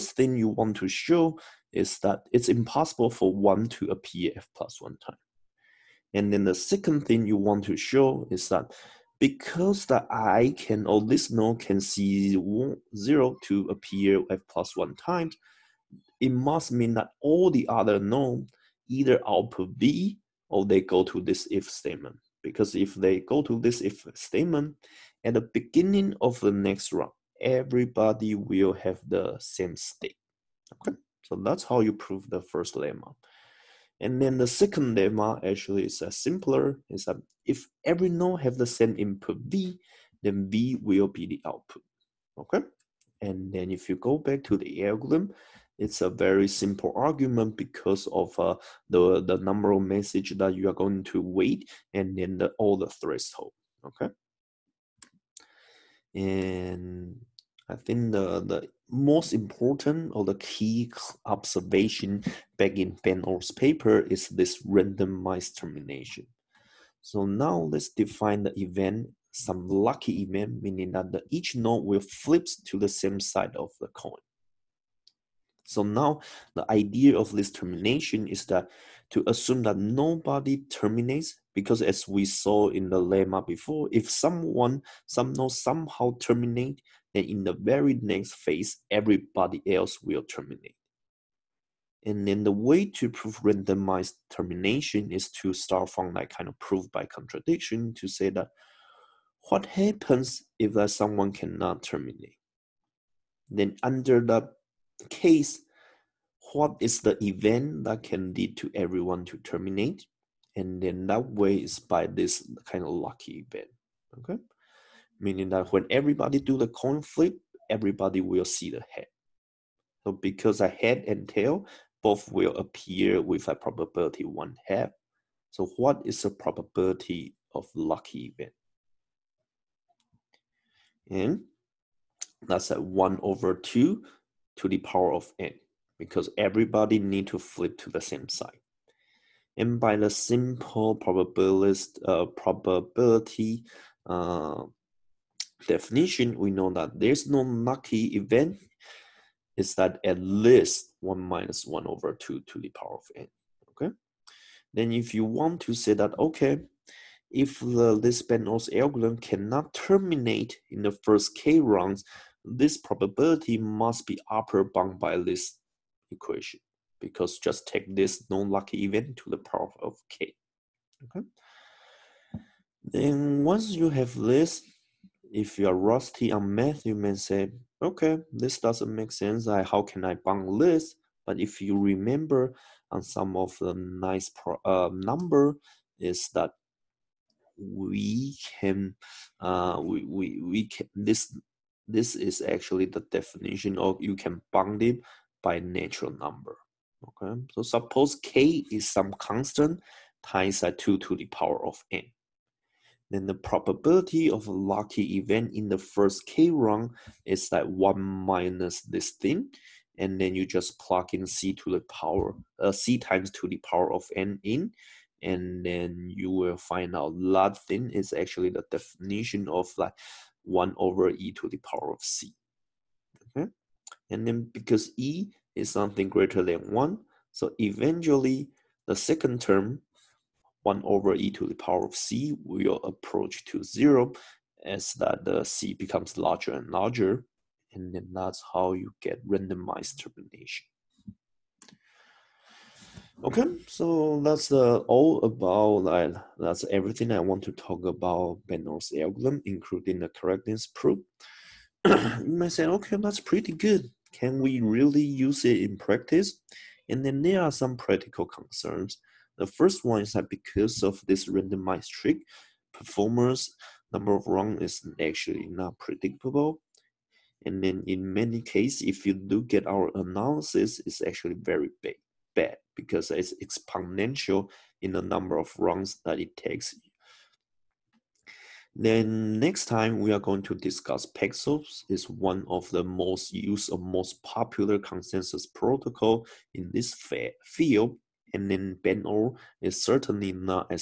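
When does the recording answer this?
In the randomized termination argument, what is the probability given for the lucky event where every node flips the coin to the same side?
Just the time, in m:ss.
2:12.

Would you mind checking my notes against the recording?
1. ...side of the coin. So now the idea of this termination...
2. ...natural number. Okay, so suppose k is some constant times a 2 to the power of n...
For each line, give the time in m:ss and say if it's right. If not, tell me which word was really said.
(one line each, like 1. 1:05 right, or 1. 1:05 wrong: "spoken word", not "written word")
1. 1:13 right
2. 3:15 right.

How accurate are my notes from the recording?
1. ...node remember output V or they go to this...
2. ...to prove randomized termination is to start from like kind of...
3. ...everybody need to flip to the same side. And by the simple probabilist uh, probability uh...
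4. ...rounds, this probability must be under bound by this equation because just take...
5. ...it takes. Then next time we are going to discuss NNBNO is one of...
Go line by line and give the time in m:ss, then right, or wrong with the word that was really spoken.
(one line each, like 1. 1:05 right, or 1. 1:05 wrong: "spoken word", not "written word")
1. 0:17 wrong: "either", not "remember"
2. 1:32 right
3. 2:16 right
4. 2:41 wrong: "upper", not "under"
5. 4:36 wrong: "Paxos", not "NNBNO".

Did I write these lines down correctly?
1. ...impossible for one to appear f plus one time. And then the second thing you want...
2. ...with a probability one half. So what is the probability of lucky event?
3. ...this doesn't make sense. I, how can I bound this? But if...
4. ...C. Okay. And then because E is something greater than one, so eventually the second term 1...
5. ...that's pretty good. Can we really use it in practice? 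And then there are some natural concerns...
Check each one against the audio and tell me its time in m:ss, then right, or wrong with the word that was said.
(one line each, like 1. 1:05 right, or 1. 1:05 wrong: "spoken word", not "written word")
1. 0:02 right
2. 2:03 right
3. 2:58 right
4. 3:42 right
5. 4:12 wrong: "practical", not "natural".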